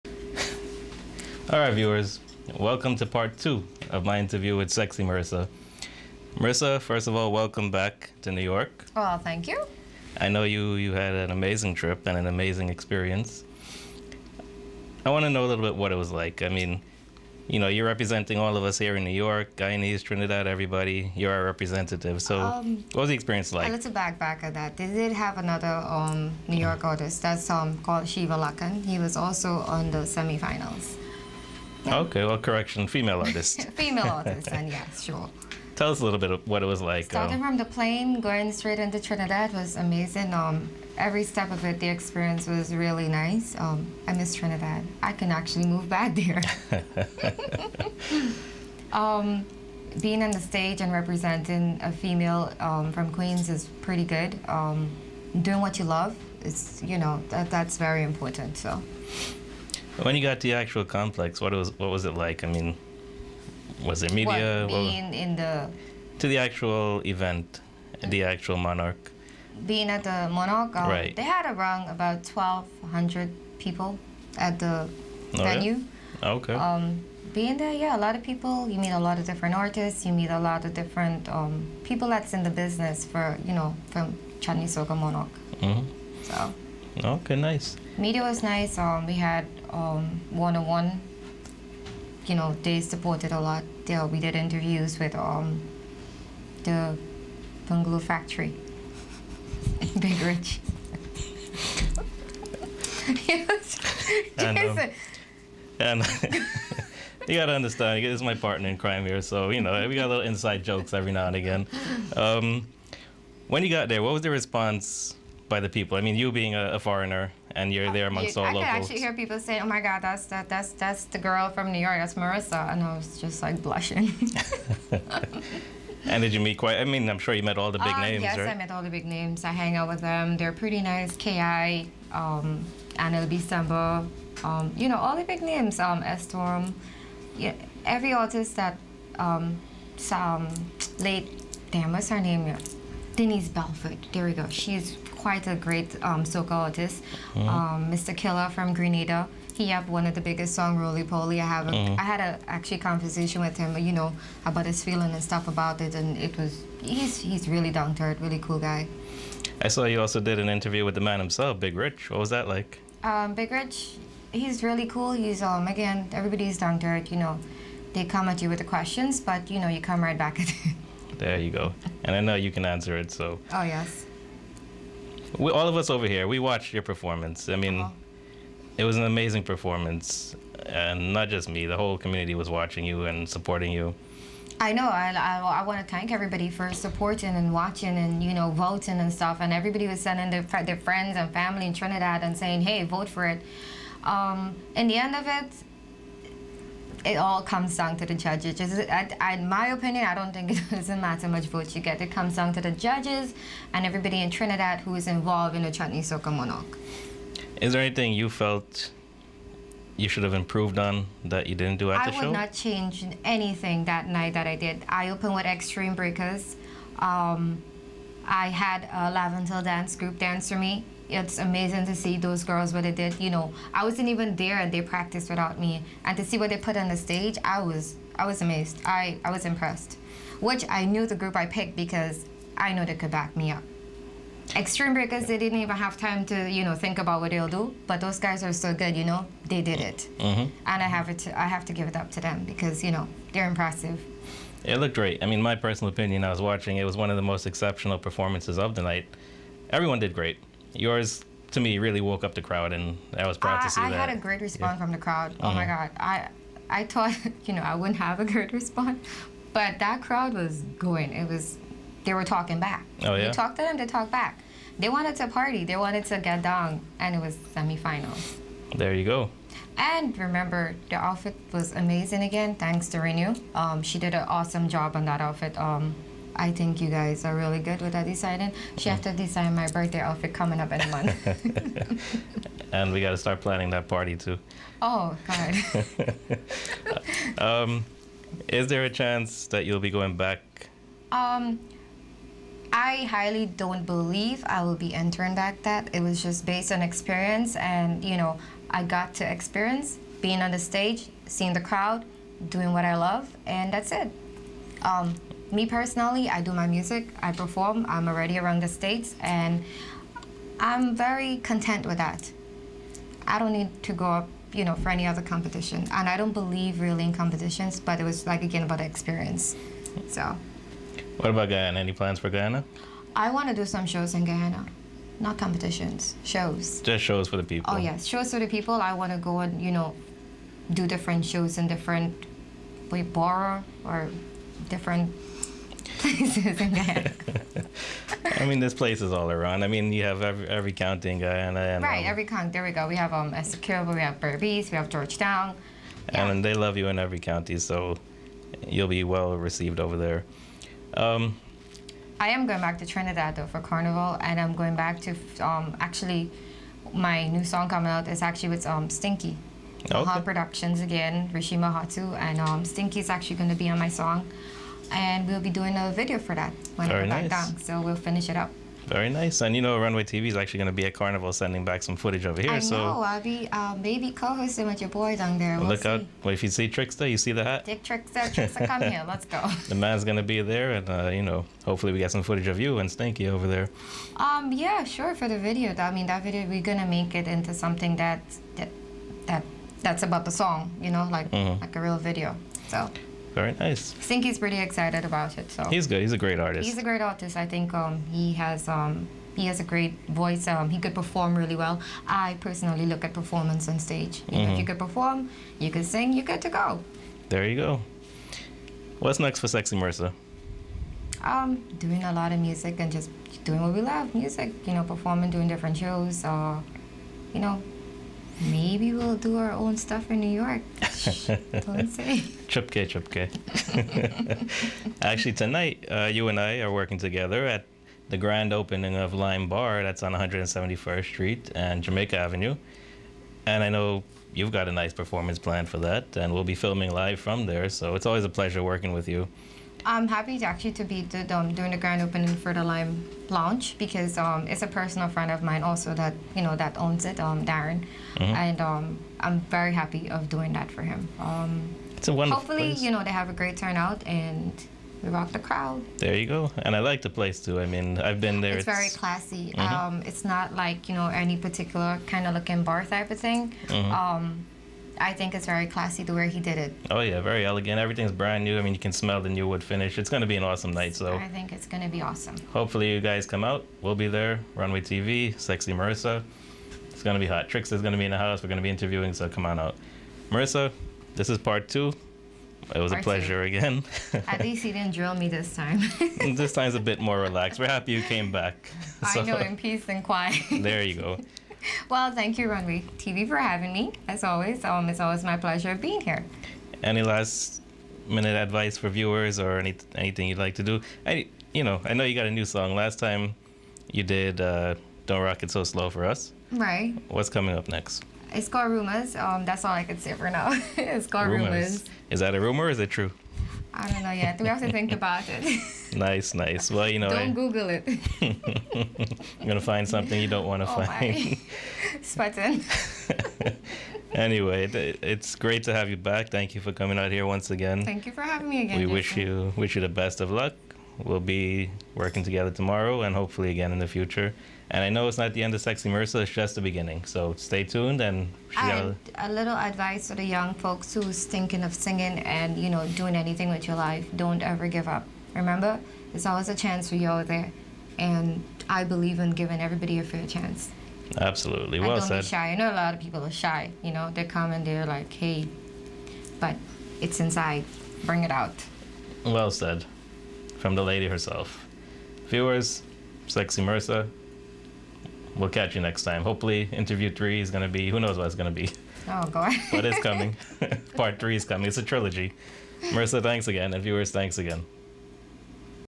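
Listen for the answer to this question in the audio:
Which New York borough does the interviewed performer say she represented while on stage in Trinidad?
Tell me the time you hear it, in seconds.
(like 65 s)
53 s.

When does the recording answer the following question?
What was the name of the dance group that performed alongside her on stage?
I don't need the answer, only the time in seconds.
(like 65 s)
219 s.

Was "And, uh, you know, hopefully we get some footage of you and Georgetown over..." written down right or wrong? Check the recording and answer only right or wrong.
wrong.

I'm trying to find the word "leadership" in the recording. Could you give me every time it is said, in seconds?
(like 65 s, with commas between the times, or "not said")
not said.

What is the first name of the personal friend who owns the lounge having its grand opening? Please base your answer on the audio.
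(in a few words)
Darren.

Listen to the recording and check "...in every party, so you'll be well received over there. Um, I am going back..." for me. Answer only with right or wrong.
wrong.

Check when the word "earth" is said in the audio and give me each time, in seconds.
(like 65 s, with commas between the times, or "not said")
158 s, 166 s.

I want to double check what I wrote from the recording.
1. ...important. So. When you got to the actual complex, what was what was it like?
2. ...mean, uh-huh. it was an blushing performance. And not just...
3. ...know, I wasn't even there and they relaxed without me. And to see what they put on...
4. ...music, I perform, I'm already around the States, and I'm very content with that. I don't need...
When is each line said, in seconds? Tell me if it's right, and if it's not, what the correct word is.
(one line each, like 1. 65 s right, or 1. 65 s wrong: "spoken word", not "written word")
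1. 58 s right
2. 177 s wrong: "amazing", not "blushing"
3. 223 s wrong: "practiced", not "relaxed"
4. 306 s right.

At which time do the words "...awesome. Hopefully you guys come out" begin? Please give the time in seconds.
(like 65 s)
472 s.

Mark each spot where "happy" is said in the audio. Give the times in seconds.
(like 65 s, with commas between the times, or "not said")
440 s, 449 s, 487 s.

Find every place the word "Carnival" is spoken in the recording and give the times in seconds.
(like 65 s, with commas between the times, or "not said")
353 s, 370 s.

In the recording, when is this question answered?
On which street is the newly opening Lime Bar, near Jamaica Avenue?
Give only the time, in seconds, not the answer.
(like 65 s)
430 s.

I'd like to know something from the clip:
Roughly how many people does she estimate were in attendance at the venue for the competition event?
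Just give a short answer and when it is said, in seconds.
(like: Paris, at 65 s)
1200, at 72 s.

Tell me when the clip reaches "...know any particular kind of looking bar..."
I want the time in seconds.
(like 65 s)
460 s.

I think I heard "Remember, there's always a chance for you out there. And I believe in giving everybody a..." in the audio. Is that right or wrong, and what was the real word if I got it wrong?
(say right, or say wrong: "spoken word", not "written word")
right.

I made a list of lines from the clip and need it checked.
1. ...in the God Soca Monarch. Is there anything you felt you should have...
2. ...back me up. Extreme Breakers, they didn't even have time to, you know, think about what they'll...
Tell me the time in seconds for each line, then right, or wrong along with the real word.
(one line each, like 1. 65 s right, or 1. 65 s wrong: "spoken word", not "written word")
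1. 205 s wrong: "Chutney", not "God"
2. 233 s right.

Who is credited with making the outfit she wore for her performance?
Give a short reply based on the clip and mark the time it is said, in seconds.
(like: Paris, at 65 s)
Renu, at 272 s.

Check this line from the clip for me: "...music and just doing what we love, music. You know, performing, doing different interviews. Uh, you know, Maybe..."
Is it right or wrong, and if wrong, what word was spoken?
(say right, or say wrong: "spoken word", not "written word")
wrong: "shows", not "interviews".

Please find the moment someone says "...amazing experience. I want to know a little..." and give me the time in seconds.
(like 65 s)
12 s.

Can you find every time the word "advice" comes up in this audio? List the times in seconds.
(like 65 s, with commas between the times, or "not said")
498 s, 539 s.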